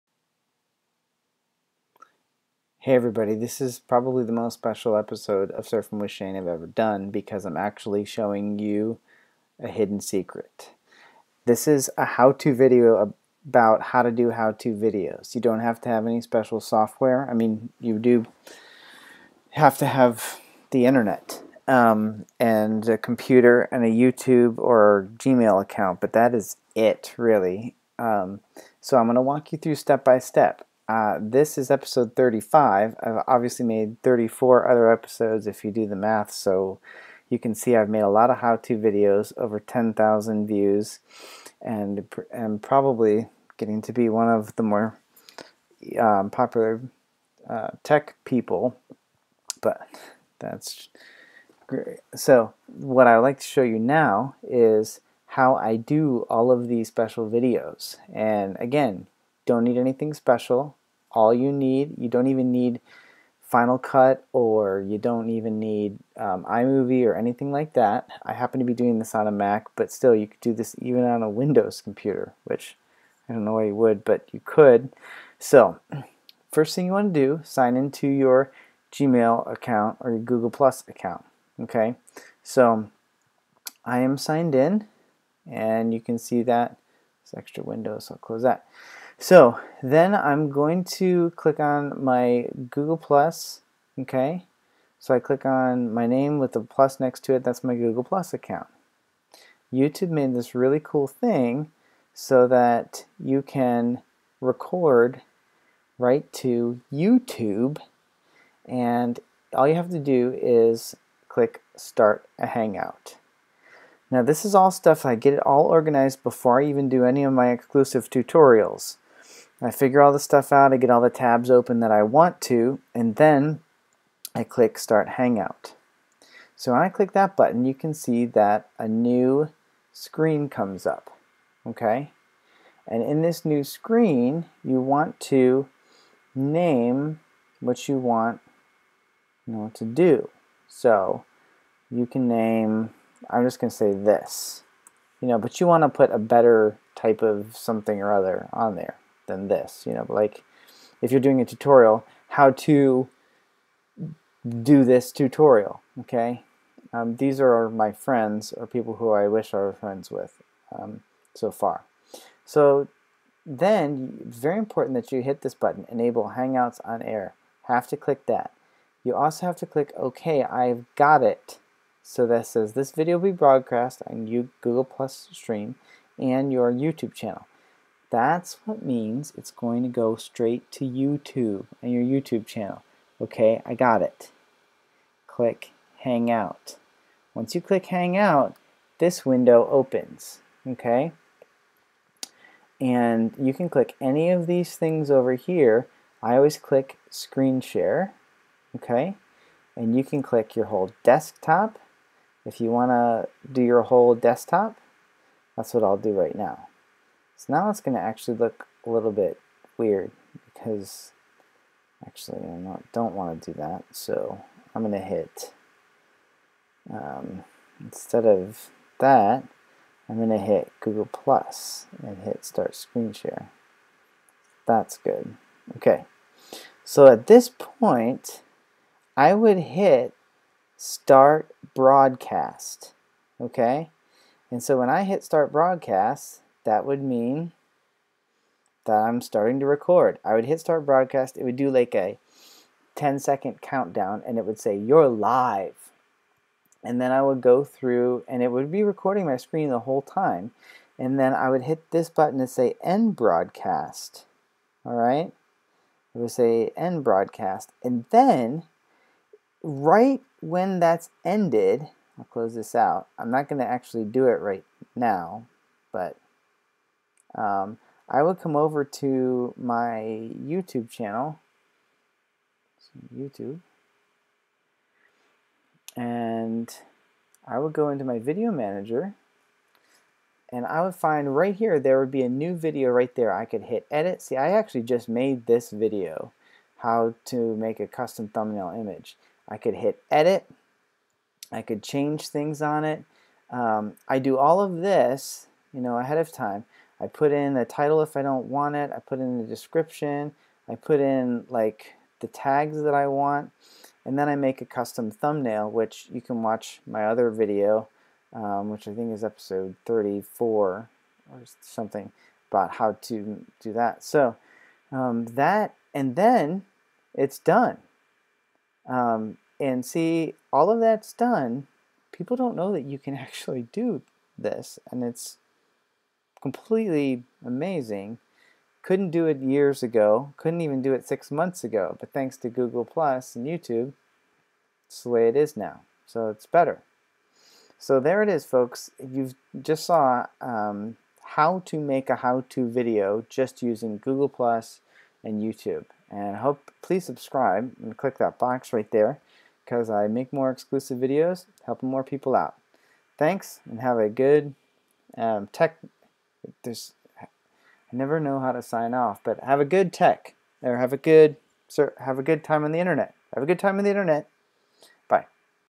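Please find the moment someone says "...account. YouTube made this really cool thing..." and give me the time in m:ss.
1:38.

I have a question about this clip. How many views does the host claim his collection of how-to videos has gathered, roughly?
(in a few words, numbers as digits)
over 10,000.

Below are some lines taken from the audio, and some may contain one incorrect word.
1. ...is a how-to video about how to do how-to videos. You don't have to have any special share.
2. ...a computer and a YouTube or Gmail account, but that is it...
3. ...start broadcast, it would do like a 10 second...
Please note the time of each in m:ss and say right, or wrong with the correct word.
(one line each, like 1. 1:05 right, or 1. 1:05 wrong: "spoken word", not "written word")
1. 0:11 wrong: "software", not "share"
2. 0:22 right
3. 4:00 right.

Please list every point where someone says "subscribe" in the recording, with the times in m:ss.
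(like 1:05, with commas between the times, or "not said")
5:47.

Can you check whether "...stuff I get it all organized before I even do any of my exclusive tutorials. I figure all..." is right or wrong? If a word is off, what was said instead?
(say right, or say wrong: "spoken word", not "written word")
right.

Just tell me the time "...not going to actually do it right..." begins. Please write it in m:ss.
4:23.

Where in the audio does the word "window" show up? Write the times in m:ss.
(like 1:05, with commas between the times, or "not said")
1:11, 1:27, 3:09.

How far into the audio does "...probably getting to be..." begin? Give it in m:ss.
0:42.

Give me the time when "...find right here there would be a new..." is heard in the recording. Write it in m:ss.
4:40.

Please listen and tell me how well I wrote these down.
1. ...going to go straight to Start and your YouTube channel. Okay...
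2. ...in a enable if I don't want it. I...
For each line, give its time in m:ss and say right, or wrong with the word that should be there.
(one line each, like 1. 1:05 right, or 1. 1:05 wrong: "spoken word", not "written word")
1. 2:59 wrong: "YouTube", not "Start"
2. 4:57 wrong: "title", not "enable".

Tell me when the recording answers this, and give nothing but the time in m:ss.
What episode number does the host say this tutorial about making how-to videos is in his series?
0:31.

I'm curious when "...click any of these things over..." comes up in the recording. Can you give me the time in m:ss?
3:13.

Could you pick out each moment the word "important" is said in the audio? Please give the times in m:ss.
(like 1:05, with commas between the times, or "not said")
2:44.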